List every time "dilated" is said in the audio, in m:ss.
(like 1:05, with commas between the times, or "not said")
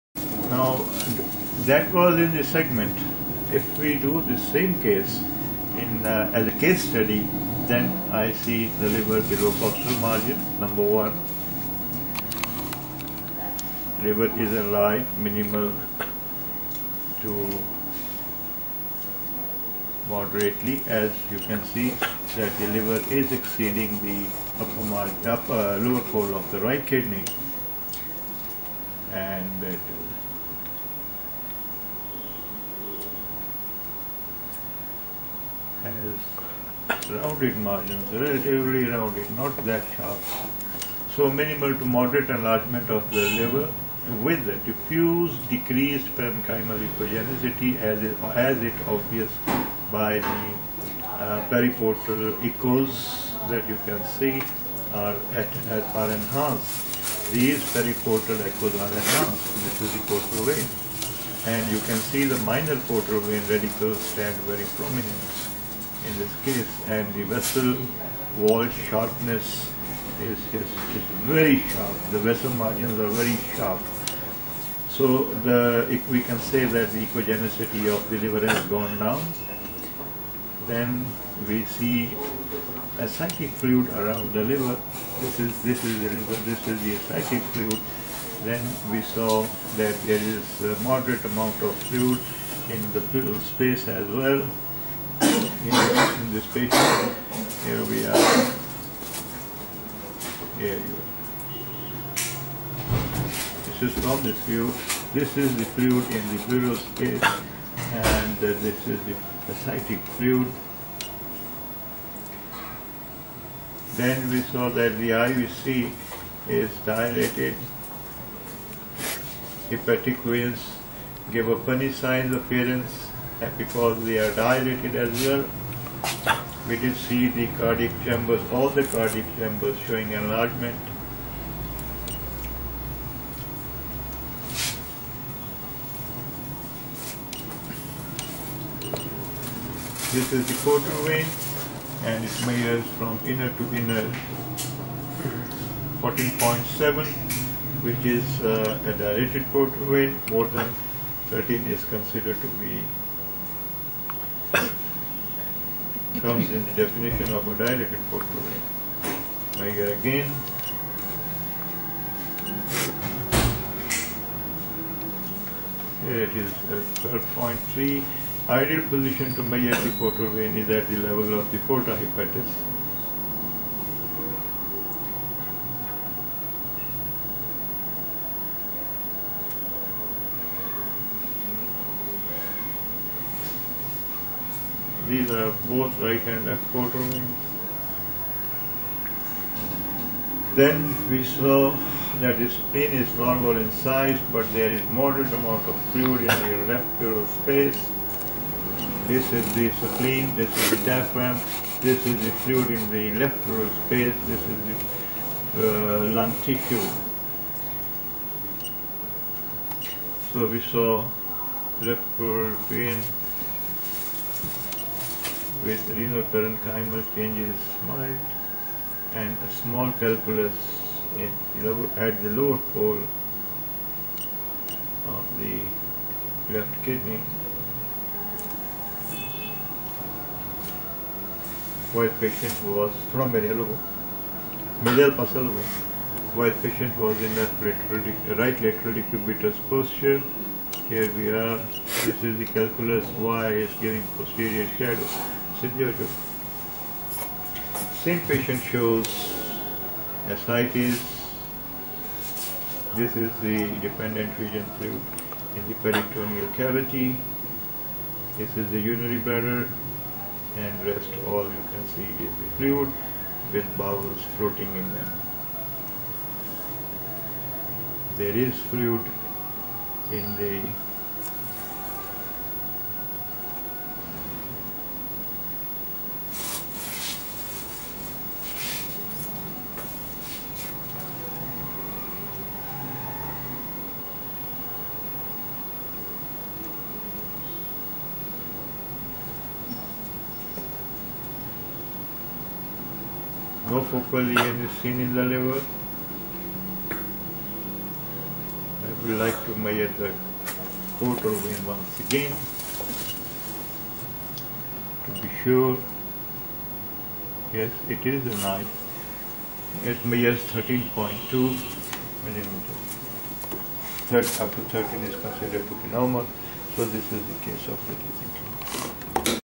1:56, 2:04, 2:28, 2:37.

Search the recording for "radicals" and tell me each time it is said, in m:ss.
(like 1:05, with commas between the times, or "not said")
1:03.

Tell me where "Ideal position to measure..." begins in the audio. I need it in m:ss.
2:48.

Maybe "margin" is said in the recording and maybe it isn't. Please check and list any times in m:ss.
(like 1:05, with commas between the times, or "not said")
0:10, 0:24, 0:37, 1:12.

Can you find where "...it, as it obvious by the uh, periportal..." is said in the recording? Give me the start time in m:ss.
0:48.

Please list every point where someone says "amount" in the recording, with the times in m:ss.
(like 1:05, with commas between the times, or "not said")
1:31, 3:15.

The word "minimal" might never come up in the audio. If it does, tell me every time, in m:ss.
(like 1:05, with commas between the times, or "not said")
0:15, 0:41.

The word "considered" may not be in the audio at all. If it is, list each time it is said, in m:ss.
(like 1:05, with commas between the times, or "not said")
2:31, 5:15.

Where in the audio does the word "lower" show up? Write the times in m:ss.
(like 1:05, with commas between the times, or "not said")
0:25, 3:42.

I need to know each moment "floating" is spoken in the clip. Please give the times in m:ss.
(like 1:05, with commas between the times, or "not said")
4:24.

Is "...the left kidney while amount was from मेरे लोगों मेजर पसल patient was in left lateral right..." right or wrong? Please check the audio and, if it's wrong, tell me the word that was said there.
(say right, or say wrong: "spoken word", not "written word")
wrong: "patient", not "amount".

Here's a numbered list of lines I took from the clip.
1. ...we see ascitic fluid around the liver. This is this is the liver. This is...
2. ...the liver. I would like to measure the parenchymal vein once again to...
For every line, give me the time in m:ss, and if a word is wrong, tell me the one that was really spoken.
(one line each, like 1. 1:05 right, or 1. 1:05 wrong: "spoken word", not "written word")
1. 1:21 right
2. 4:55 wrong: "portal", not "parenchymal".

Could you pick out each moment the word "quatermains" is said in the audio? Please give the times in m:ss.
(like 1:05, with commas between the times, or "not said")
3:06.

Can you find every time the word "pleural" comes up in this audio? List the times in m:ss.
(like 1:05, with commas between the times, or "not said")
1:46, 3:16, 3:23, 3:32.